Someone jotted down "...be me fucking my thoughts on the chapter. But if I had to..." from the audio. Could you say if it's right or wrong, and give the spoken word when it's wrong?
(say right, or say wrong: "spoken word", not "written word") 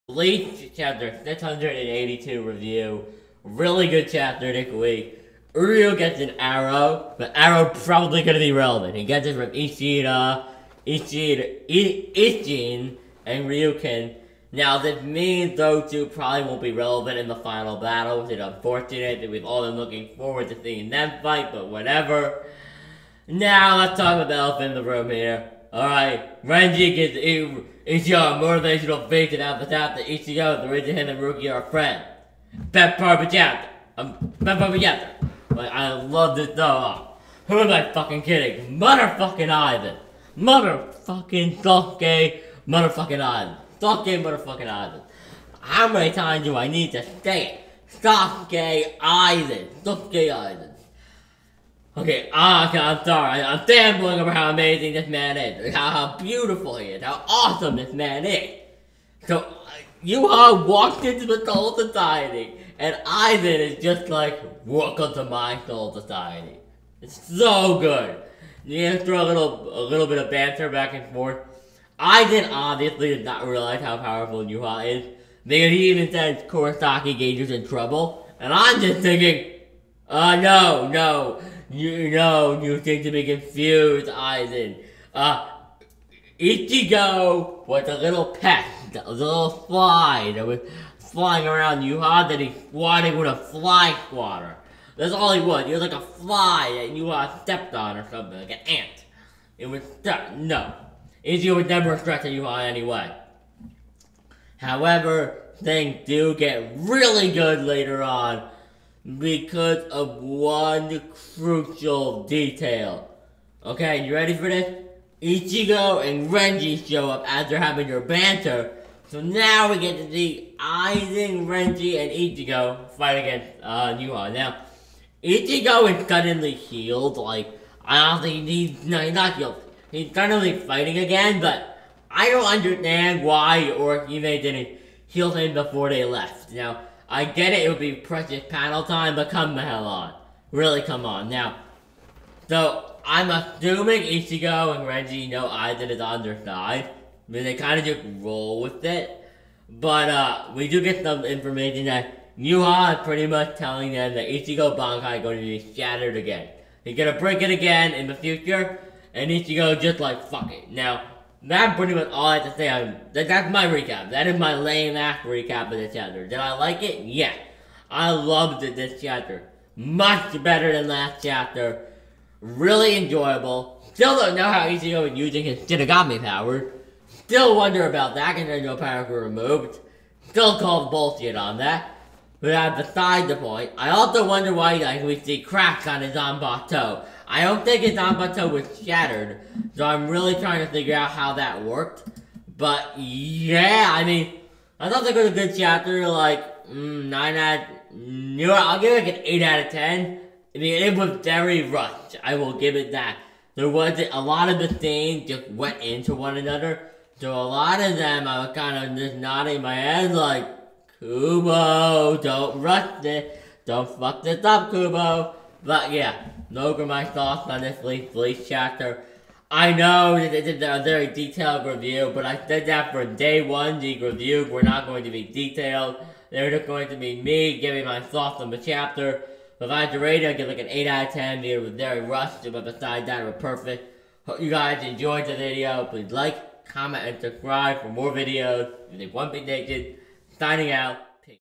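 wrong: "giving", not "fucking".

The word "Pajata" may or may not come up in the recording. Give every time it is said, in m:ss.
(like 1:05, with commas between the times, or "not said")
0:33.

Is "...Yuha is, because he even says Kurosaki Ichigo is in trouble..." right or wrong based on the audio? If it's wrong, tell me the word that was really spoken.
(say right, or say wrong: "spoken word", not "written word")
wrong: "Gage", not "Ichigo".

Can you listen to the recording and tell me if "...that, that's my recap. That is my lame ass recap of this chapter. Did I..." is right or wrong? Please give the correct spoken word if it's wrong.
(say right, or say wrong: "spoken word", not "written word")
right.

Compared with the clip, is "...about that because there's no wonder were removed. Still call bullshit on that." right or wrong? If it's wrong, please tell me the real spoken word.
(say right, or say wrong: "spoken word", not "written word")
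wrong: "power", not "wonder".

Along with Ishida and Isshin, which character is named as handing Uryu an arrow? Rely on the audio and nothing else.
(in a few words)
Ryuken.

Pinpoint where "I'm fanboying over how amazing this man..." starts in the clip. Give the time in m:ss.
0:53.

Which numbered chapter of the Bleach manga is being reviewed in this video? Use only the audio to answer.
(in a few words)
682.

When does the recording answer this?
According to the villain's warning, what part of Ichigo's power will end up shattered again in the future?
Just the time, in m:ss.
2:34.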